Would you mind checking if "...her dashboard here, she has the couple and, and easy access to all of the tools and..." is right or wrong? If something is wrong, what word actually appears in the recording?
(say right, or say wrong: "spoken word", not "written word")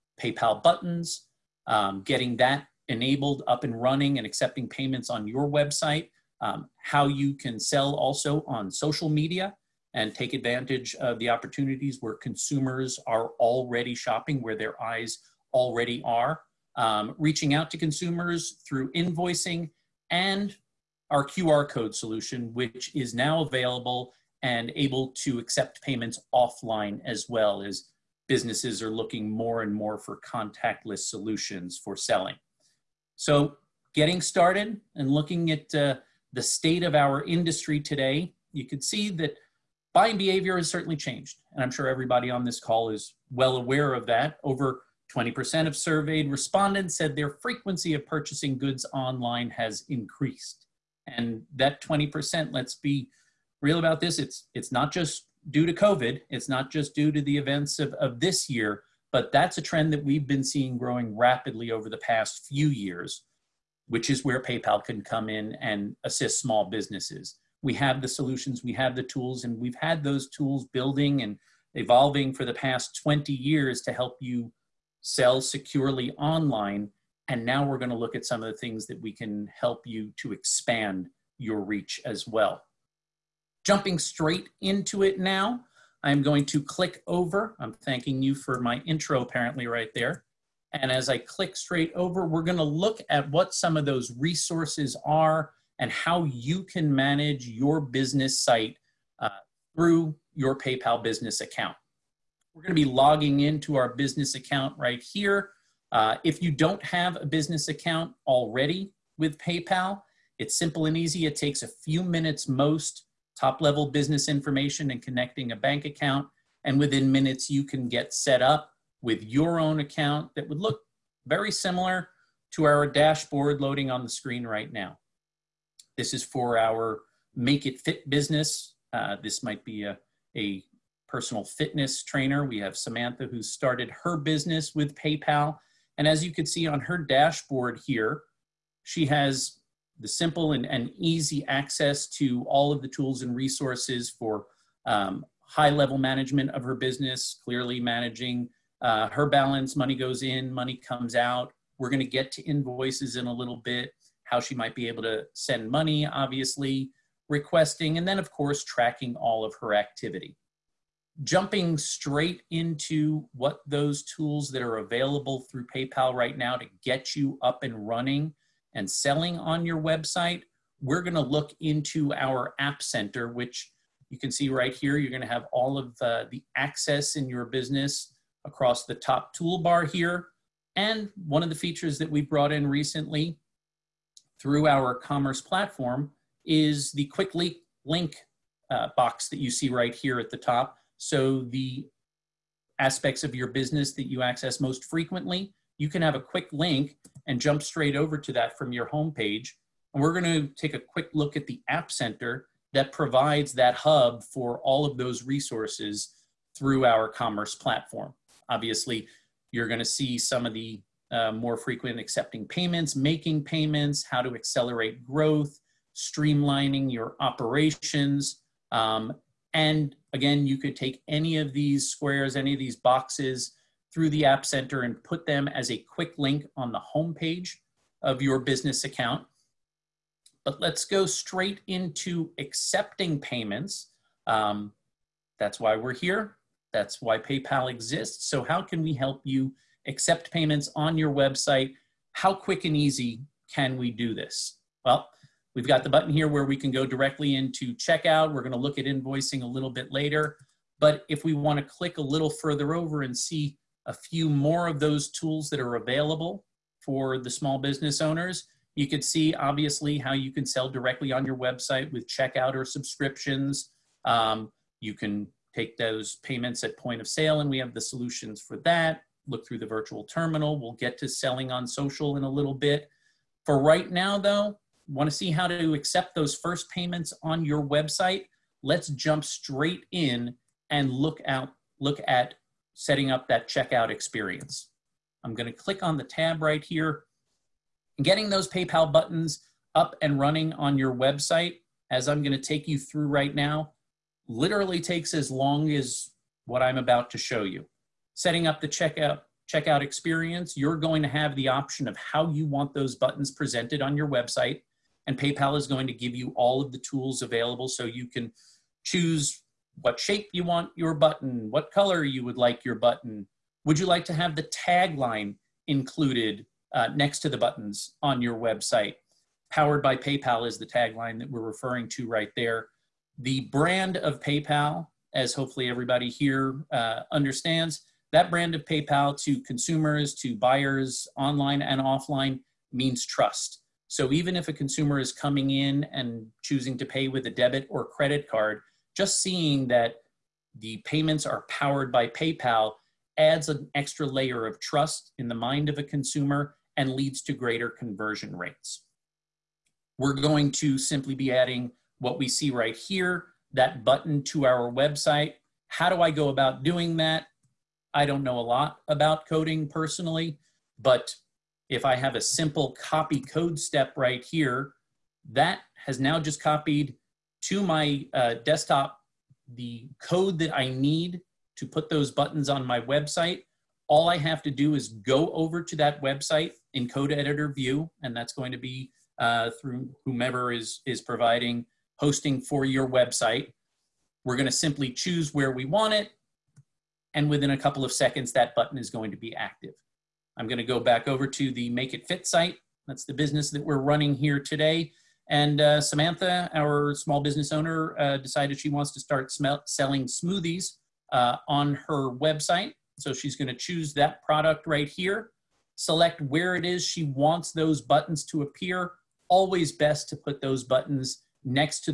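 wrong: "simple", not "couple".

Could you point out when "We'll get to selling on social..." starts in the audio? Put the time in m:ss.
4:30.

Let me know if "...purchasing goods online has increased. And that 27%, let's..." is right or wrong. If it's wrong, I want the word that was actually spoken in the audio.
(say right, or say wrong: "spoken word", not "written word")
wrong: "20", not "27".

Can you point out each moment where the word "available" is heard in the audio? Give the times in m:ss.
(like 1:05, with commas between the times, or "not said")
0:23, 2:44, 4:15, 5:07.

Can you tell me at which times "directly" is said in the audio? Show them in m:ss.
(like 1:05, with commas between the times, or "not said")
4:06, 4:20.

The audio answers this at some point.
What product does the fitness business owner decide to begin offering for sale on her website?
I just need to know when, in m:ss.
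6:40.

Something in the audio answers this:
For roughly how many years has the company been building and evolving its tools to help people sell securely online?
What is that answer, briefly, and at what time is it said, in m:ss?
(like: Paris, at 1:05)
20 years, at 1:13.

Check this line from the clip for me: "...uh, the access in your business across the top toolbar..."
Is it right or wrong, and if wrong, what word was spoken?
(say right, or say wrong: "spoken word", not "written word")
right.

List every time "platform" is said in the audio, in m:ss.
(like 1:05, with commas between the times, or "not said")
3:05, 3:27.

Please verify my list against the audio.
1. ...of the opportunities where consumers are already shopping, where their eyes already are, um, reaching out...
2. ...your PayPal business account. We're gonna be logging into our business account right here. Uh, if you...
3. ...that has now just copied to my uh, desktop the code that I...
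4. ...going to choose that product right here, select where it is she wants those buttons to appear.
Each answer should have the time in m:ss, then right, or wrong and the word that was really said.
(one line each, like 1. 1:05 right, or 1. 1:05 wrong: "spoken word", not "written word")
1. 0:10 right
2. 1:40 right
3. 6:05 right
4. 6:43 right.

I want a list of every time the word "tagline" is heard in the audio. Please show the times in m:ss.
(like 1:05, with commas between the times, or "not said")
5:14, 5:20.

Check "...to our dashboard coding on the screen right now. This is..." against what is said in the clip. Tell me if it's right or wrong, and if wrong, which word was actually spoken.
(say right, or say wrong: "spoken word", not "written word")
wrong: "loading", not "coding".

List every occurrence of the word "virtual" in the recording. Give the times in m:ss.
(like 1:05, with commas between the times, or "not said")
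4:29.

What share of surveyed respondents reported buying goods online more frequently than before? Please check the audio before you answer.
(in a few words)
Over 20%.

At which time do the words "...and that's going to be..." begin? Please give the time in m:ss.
6:18.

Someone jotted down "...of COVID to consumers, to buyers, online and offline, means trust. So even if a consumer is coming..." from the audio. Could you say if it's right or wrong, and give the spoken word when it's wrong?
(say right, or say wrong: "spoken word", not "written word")
wrong: "PayPal", not "COVID".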